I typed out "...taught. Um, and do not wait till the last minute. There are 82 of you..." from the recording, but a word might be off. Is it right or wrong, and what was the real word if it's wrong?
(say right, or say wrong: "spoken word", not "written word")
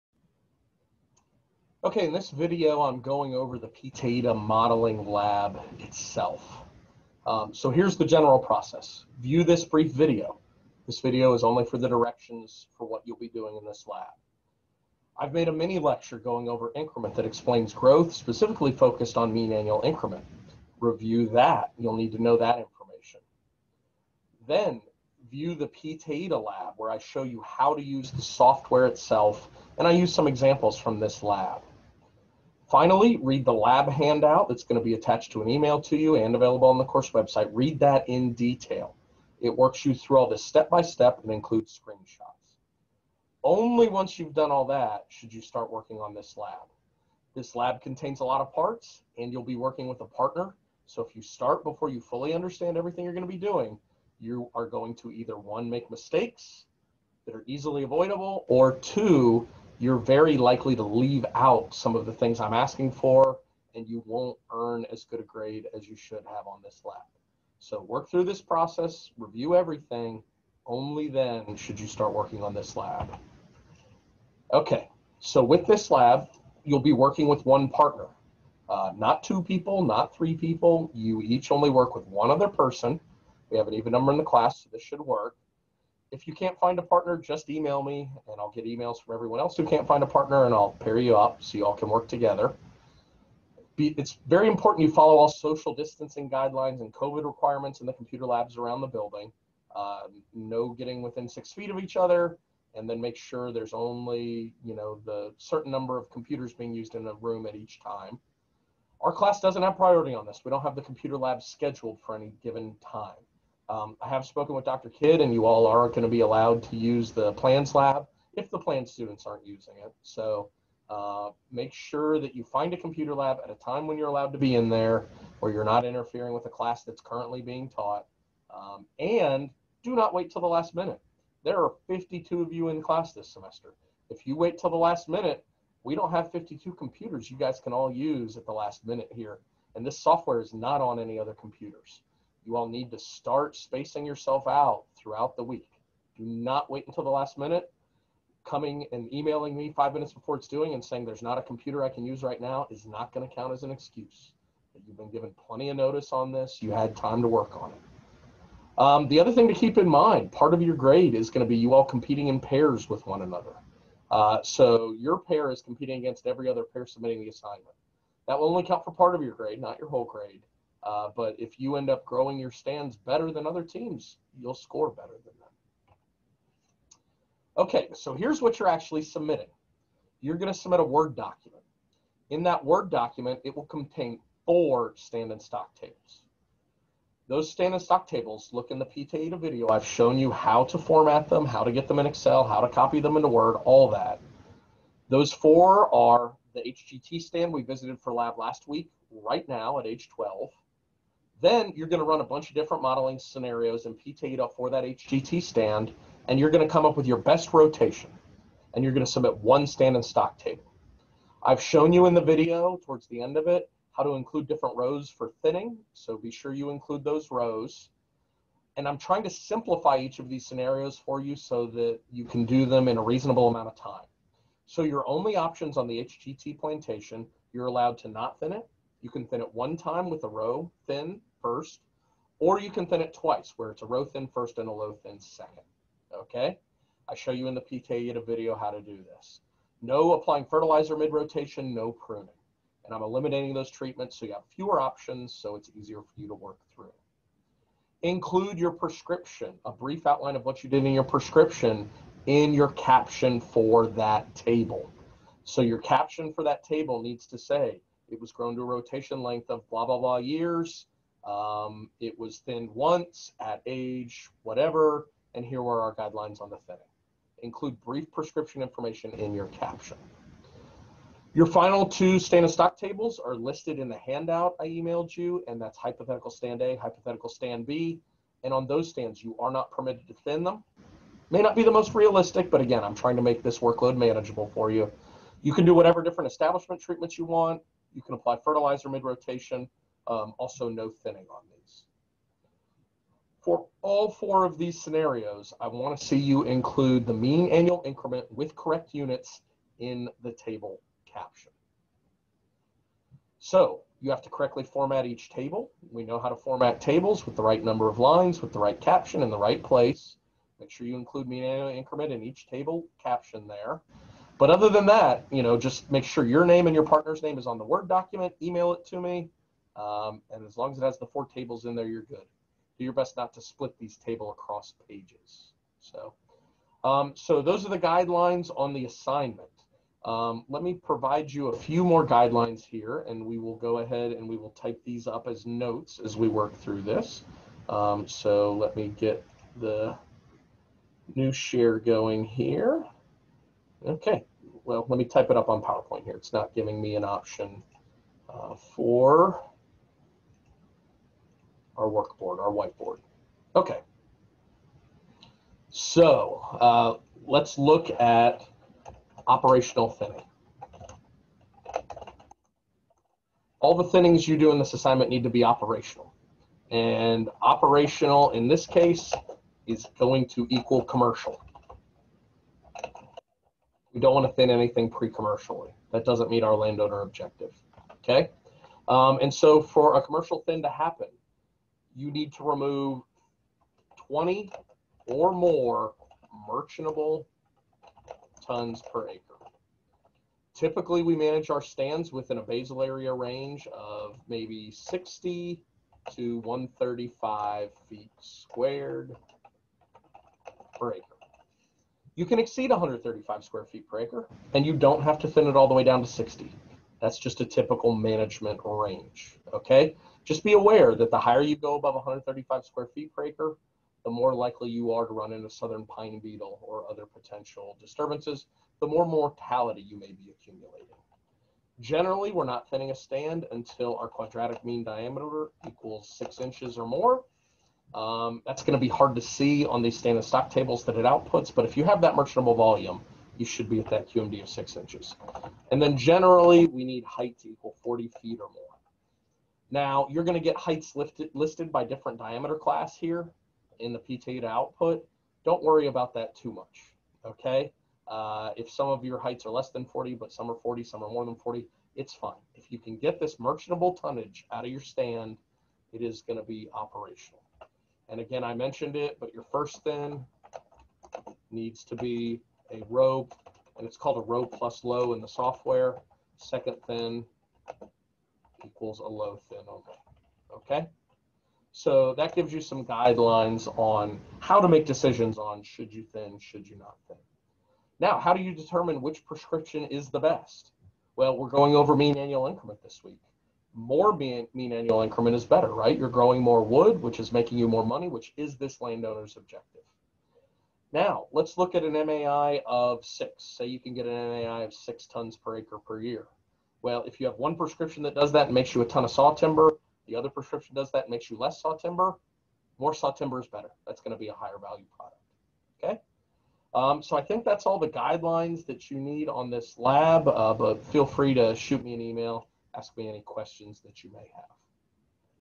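wrong: "52", not "82".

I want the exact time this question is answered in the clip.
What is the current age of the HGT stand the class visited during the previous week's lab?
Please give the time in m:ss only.
3:20.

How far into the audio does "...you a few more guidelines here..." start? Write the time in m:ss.
5:31.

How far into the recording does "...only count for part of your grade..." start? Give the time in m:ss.
2:48.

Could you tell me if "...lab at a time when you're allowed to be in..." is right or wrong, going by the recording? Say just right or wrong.
right.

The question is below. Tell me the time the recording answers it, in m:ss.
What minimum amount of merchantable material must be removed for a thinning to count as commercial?
6:24.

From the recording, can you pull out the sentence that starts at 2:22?
You all need to start spacing yourself out throughout the week.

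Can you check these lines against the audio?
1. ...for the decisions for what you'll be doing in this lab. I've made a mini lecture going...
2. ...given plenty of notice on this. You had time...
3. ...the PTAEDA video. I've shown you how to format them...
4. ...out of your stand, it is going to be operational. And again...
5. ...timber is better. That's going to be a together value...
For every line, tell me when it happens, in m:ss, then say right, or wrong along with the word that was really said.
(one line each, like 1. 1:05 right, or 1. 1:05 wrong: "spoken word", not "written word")
1. 0:11 wrong: "directions", not "decisions"
2. 2:35 right
3. 3:08 right
4. 7:34 right
5. 8:23 wrong: "higher", not "together".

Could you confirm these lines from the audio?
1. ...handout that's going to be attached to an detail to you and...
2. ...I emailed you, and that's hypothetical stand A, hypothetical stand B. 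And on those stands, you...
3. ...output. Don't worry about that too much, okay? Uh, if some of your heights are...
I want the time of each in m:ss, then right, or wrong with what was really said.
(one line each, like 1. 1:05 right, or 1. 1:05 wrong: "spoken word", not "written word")
1. 0:33 wrong: "email", not "detail"
2. 4:34 right
3. 7:24 right.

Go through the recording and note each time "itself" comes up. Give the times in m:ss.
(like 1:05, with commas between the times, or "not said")
0:05, 0:28.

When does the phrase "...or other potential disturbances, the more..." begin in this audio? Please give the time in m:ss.
6:56.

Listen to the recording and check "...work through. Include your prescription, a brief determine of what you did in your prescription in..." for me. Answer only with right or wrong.
wrong.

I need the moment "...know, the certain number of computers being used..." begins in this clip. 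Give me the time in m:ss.
1:44.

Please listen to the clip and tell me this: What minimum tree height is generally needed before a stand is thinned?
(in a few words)
40 feet.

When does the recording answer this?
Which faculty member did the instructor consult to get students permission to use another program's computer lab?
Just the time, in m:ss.
1:54.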